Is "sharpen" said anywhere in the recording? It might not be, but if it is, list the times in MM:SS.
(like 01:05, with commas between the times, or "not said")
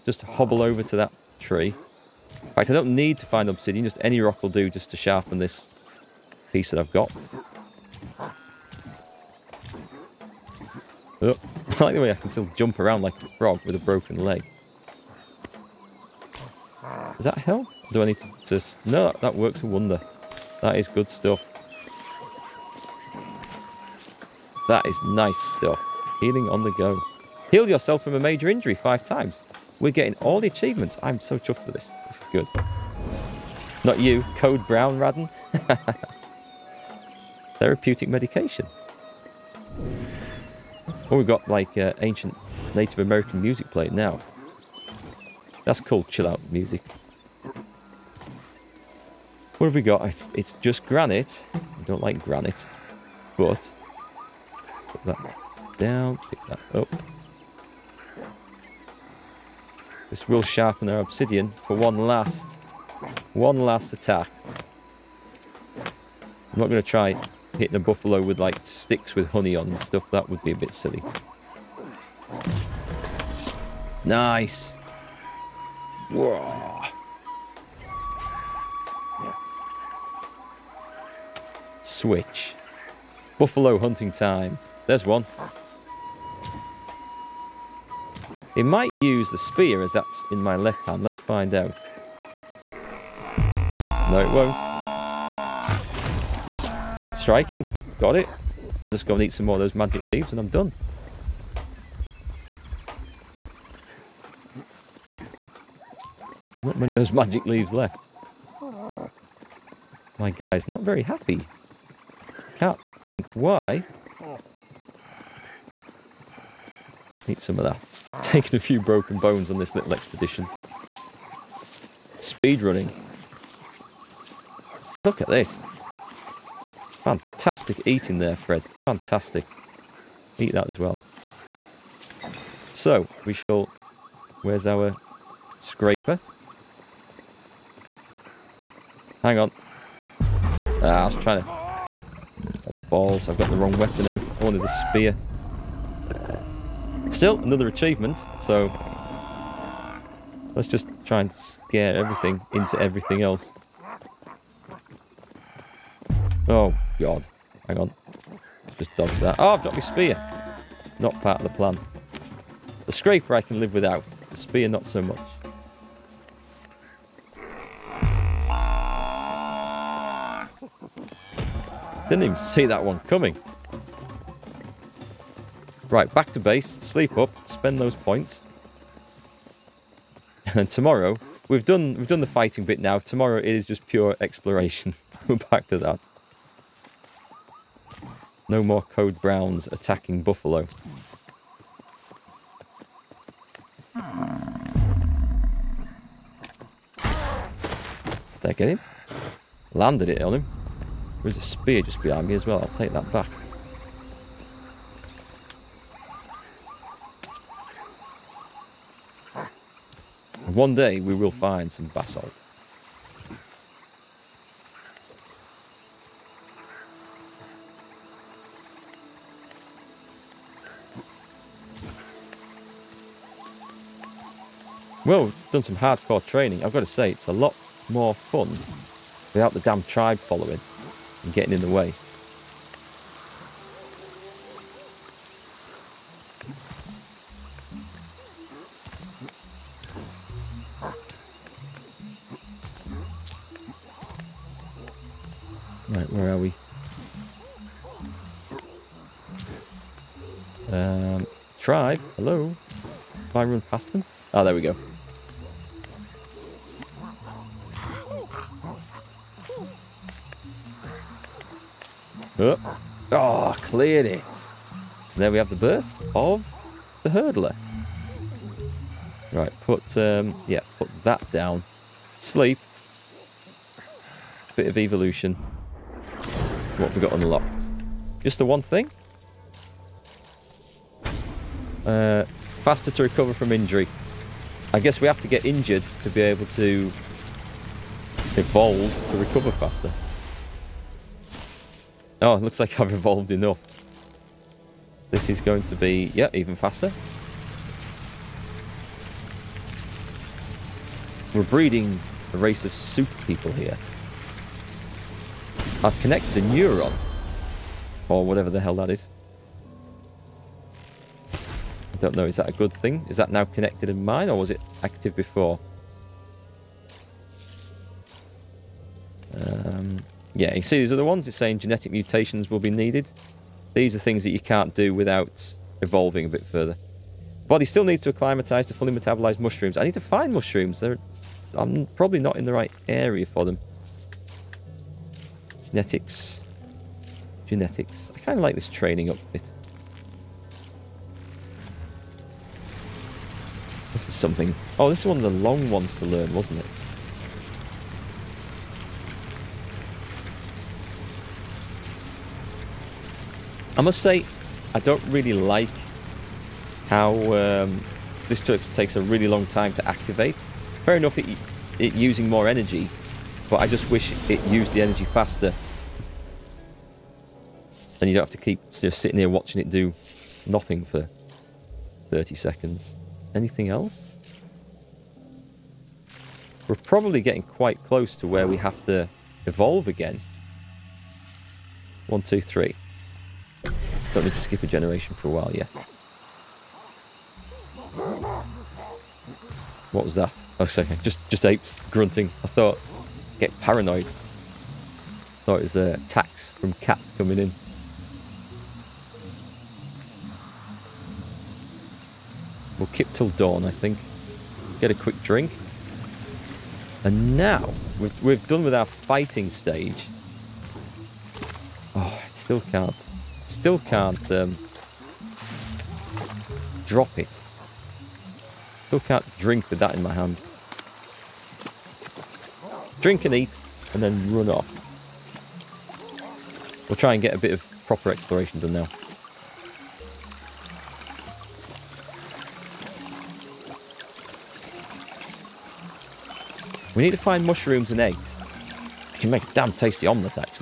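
00:04, 01:00.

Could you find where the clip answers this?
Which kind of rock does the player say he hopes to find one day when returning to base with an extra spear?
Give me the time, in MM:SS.
03:31.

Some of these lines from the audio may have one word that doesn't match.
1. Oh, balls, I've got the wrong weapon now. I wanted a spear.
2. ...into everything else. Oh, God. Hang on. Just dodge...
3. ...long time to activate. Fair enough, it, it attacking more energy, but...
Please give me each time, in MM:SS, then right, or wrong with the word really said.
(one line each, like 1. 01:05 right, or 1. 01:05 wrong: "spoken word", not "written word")
1. 02:21 right
2. 02:32 right
3. 05:59 wrong: "using", not "attacking".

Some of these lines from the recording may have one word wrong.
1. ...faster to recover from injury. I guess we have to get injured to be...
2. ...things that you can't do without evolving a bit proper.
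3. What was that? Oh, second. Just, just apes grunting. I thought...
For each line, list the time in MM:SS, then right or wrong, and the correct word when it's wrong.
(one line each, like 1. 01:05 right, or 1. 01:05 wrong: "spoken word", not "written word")
1. 04:42 right
2. 05:23 wrong: "further", not "proper"
3. 06:29 right.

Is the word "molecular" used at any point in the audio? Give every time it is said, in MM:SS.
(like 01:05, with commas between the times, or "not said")
not said.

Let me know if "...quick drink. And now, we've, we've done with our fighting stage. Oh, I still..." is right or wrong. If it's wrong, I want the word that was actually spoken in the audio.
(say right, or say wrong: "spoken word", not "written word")
right.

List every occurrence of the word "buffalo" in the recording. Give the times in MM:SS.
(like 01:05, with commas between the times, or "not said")
01:07, 01:23, 03:10.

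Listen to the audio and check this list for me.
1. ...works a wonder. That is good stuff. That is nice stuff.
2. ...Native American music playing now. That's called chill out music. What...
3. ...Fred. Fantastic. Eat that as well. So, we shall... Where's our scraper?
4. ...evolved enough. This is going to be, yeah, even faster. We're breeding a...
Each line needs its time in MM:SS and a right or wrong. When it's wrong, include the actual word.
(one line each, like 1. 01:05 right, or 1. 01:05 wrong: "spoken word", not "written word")
1. 00:19 right
2. 00:42 right
3. 02:08 right
4. 04:52 right.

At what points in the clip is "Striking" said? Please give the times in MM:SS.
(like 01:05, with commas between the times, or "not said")
01:37.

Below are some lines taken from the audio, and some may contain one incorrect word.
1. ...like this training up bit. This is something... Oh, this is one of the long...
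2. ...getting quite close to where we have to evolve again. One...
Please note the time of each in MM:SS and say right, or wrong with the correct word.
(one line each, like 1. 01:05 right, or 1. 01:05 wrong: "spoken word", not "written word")
1. 05:38 right
2. 06:17 right.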